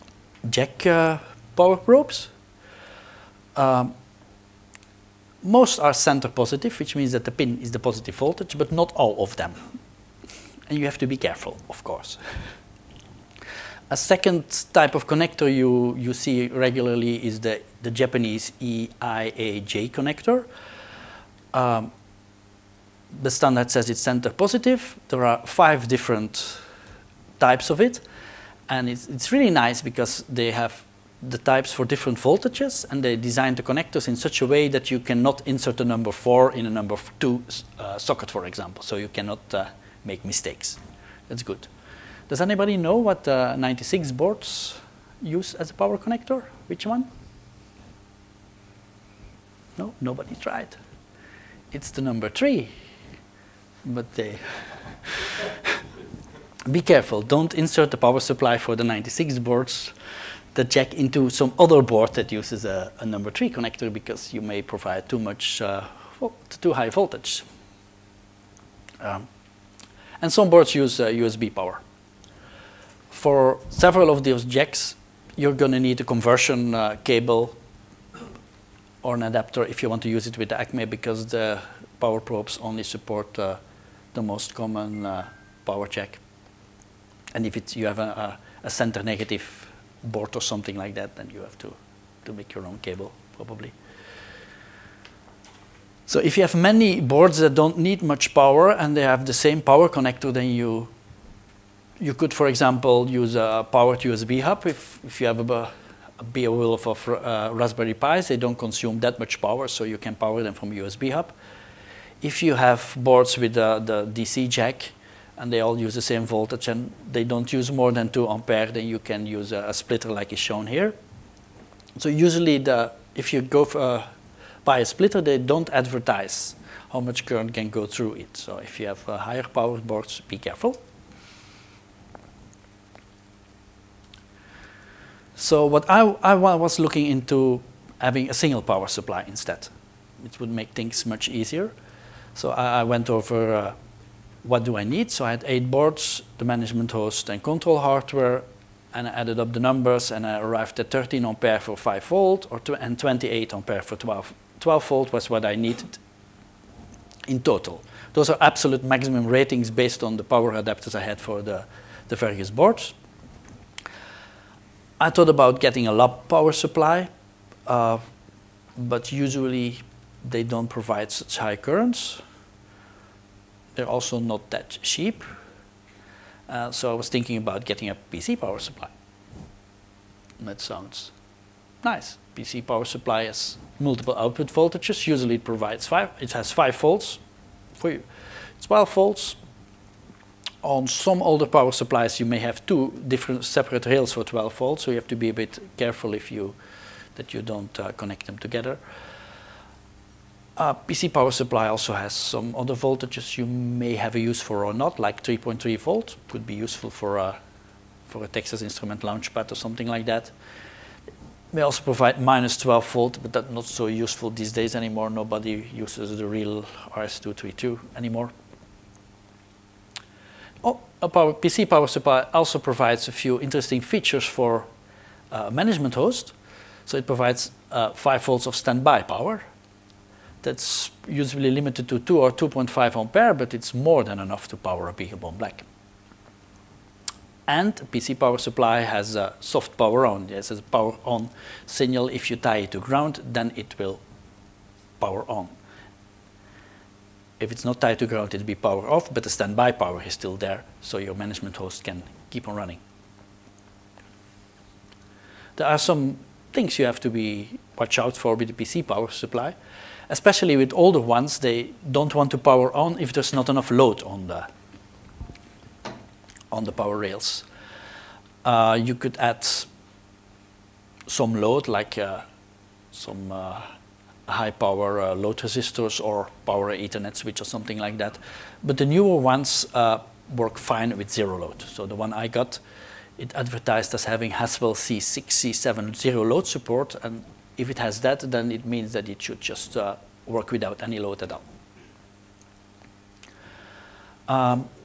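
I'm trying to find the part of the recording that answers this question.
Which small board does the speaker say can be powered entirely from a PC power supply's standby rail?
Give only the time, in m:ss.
3:54.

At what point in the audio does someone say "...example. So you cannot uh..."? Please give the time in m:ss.
0:38.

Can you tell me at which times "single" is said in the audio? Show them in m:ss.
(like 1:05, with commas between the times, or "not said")
2:18.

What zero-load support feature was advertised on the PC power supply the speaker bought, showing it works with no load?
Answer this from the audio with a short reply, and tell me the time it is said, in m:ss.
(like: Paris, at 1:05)
Haswell C6, C7, at 4:44.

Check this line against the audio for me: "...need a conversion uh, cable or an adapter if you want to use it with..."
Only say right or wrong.
right.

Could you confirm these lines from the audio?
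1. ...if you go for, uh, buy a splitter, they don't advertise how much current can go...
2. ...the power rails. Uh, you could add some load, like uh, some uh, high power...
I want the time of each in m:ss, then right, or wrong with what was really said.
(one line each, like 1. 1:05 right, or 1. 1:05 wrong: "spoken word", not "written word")
1. 2:03 right
2. 4:26 right.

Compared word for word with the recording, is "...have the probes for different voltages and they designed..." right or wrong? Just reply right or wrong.
wrong.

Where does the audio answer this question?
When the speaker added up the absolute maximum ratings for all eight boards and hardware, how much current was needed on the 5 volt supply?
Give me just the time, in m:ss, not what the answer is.
2:30.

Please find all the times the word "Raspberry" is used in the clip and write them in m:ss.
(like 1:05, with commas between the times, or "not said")
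1:47.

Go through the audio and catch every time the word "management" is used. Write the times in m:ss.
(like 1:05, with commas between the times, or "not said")
2:26, 3:45, 4:11.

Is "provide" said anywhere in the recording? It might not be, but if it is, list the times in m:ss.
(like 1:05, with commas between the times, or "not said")
1:04, 2:50, 3:05, 3:31, 3:42, 3:47.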